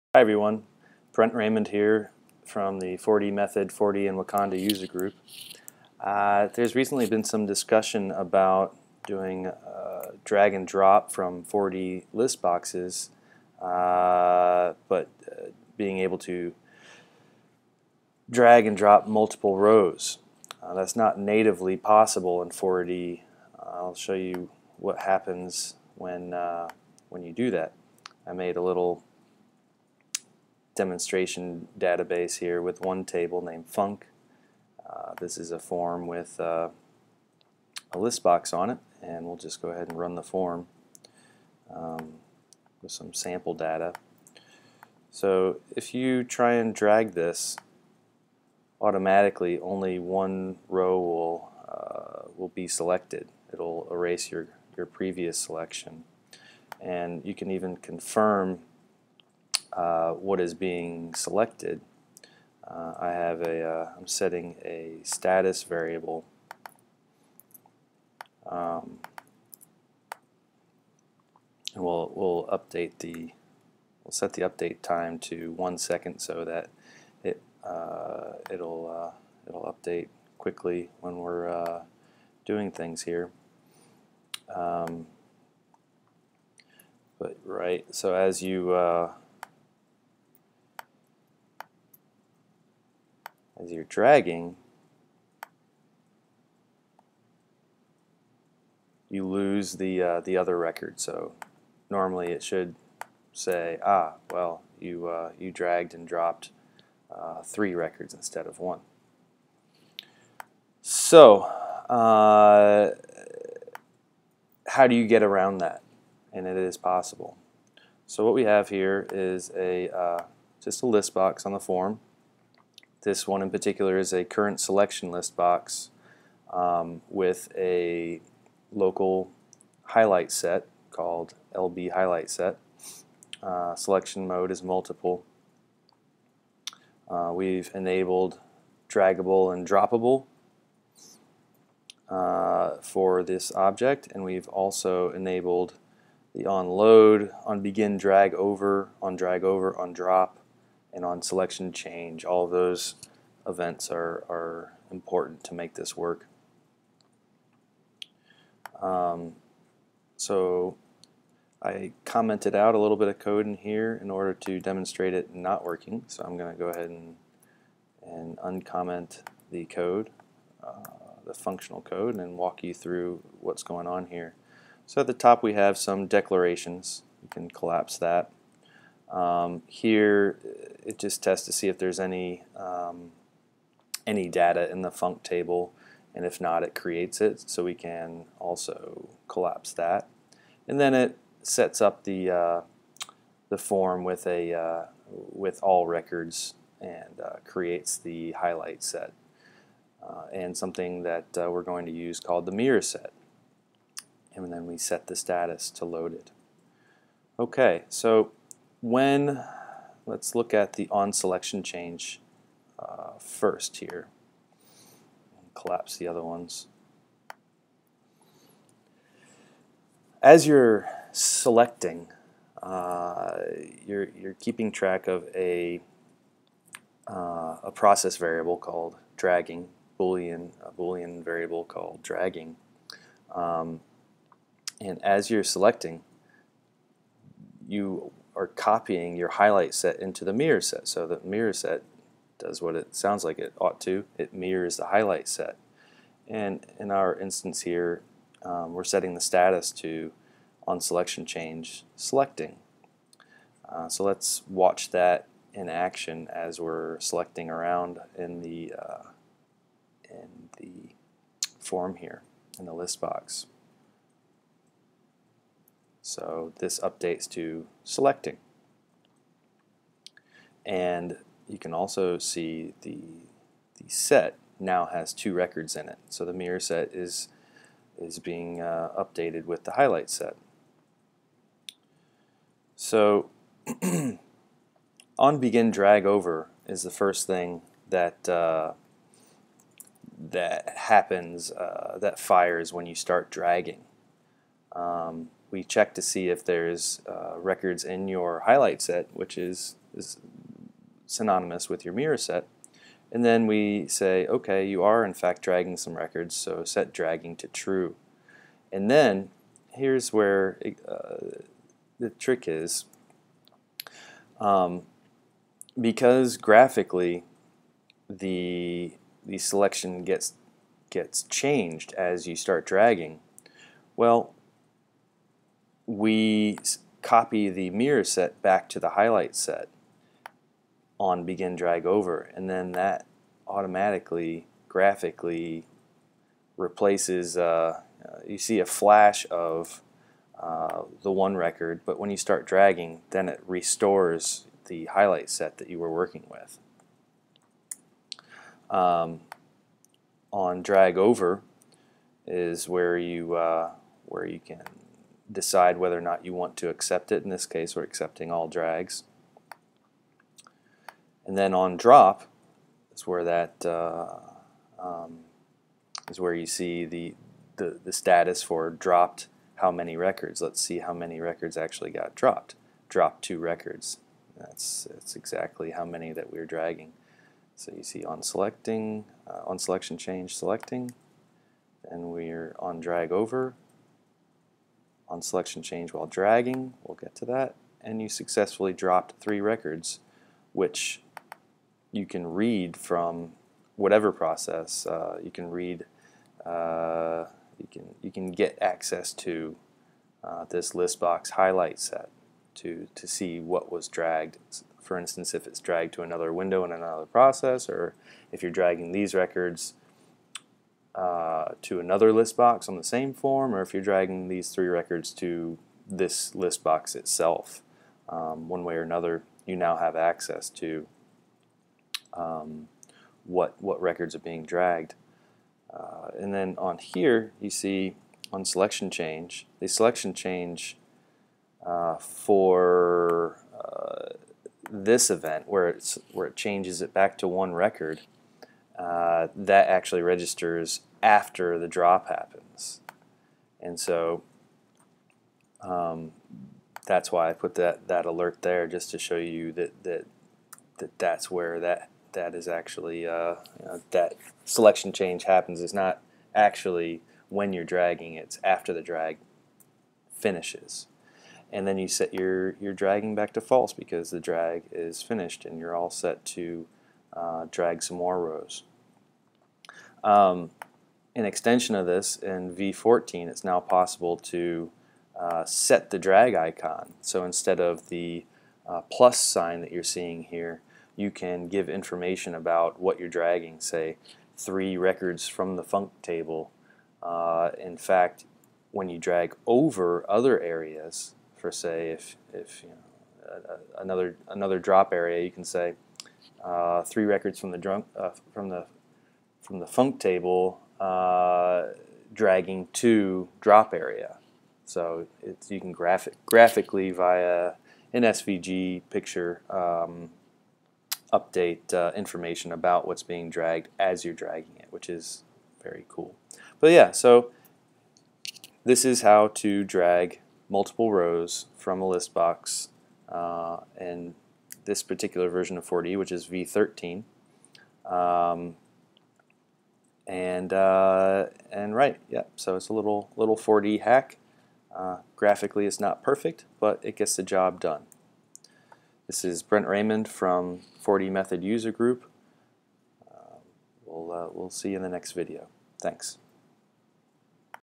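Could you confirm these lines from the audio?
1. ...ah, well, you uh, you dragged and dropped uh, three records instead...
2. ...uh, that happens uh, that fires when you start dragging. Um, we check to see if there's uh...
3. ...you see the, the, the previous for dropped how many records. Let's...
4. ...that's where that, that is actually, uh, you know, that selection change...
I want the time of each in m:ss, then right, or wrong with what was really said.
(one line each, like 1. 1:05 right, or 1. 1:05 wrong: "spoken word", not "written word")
1. 1:43 right
2. 4:48 right
3. 6:06 wrong: "status", not "previous"
4. 7:30 right.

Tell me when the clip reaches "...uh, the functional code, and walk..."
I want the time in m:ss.
2:50.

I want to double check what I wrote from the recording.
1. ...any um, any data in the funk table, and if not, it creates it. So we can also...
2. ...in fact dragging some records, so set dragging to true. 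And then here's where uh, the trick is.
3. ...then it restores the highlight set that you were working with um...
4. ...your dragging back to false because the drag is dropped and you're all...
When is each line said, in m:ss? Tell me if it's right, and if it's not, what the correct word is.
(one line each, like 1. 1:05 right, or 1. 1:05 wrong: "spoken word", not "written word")
1. 3:01 right
2. 5:05 right
3. 5:43 right
4. 7:42 wrong: "finished", not "dropped".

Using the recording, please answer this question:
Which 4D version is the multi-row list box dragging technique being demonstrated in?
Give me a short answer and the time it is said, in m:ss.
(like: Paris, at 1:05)
V13, at 8:46.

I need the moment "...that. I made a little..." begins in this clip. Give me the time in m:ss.
0:27.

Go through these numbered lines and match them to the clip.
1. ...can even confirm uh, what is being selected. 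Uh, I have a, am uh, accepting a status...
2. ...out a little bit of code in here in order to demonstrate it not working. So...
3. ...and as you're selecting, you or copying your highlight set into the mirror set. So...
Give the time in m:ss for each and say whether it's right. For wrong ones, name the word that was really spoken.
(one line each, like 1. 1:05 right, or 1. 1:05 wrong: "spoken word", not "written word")
1. 0:57 wrong: "setting", not "accepting"
2. 2:42 right
3. 3:54 right.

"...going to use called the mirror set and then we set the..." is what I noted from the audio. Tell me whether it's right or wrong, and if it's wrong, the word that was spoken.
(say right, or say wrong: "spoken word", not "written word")
right.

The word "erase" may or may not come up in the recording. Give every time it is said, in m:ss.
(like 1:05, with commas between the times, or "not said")
0:53.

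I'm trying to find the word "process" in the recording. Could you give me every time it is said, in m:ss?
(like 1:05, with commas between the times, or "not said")
3:47, 6:34, 6:47.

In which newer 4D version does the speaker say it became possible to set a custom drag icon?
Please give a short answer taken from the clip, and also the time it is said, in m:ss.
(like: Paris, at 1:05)
V14, at 7:52.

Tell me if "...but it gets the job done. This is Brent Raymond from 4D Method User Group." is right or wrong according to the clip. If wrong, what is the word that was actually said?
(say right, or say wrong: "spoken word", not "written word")
right.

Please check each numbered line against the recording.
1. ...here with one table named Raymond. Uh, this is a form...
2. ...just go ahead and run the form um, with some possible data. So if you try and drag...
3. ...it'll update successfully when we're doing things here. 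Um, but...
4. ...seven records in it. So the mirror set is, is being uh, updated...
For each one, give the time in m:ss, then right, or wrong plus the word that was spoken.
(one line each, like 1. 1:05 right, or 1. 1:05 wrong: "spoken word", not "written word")
1. 0:32 wrong: "Funk", not "Raymond"
2. 0:39 wrong: "sample", not "possible"
3. 1:19 wrong: "quickly", not "successfully"
4. 4:35 wrong: "two", not "seven".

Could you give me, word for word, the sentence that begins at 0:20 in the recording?
Uh, that's not natively possible in 4D.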